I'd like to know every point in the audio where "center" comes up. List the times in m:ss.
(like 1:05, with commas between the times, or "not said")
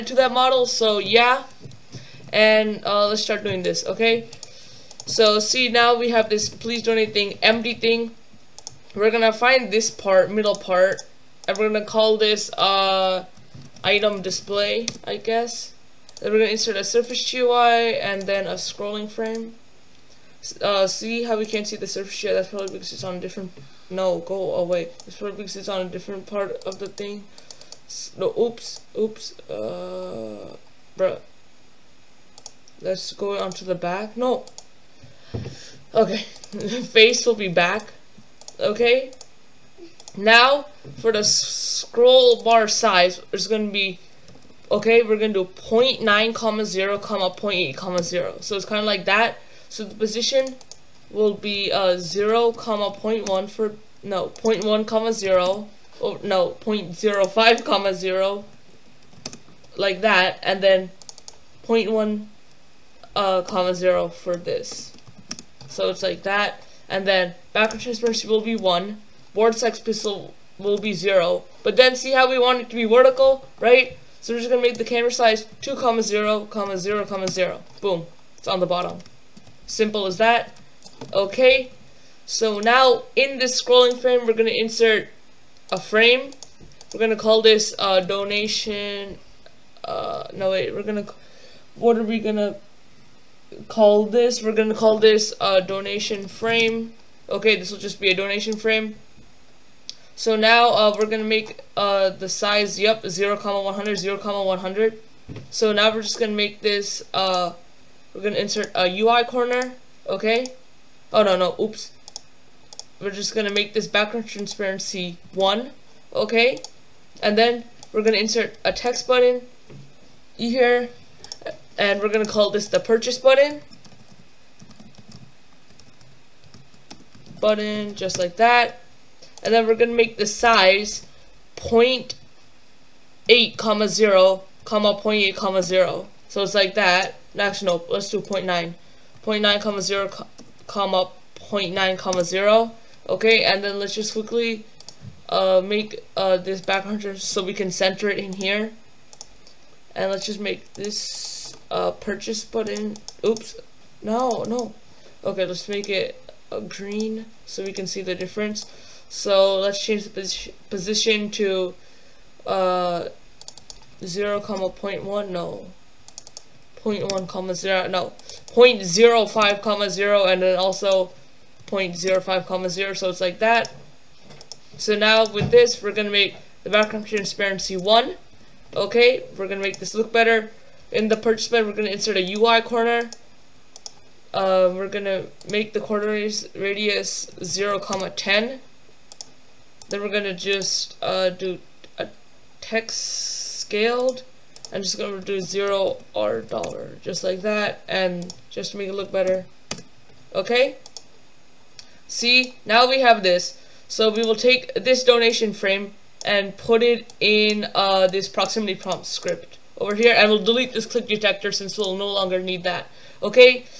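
2:27.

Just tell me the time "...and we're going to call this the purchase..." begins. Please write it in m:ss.
2:01.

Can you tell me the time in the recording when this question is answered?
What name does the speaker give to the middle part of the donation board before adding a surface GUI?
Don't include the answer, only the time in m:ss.
0:13.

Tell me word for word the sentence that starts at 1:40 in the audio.
So now uh, we're going to make uh, the size, yep, 0, comma 100, 0, comma 100.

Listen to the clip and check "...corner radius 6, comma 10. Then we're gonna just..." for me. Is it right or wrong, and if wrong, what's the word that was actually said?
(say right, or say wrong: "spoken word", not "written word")
wrong: "0", not "6".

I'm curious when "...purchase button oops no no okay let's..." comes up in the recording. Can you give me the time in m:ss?
2:31.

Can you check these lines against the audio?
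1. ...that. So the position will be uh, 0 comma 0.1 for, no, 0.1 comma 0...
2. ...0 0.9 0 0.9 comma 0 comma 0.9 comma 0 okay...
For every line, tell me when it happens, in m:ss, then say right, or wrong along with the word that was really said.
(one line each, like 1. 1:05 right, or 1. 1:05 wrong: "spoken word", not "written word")
1. 0:49 right
2. 2:18 right.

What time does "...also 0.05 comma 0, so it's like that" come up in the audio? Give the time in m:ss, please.
2:50.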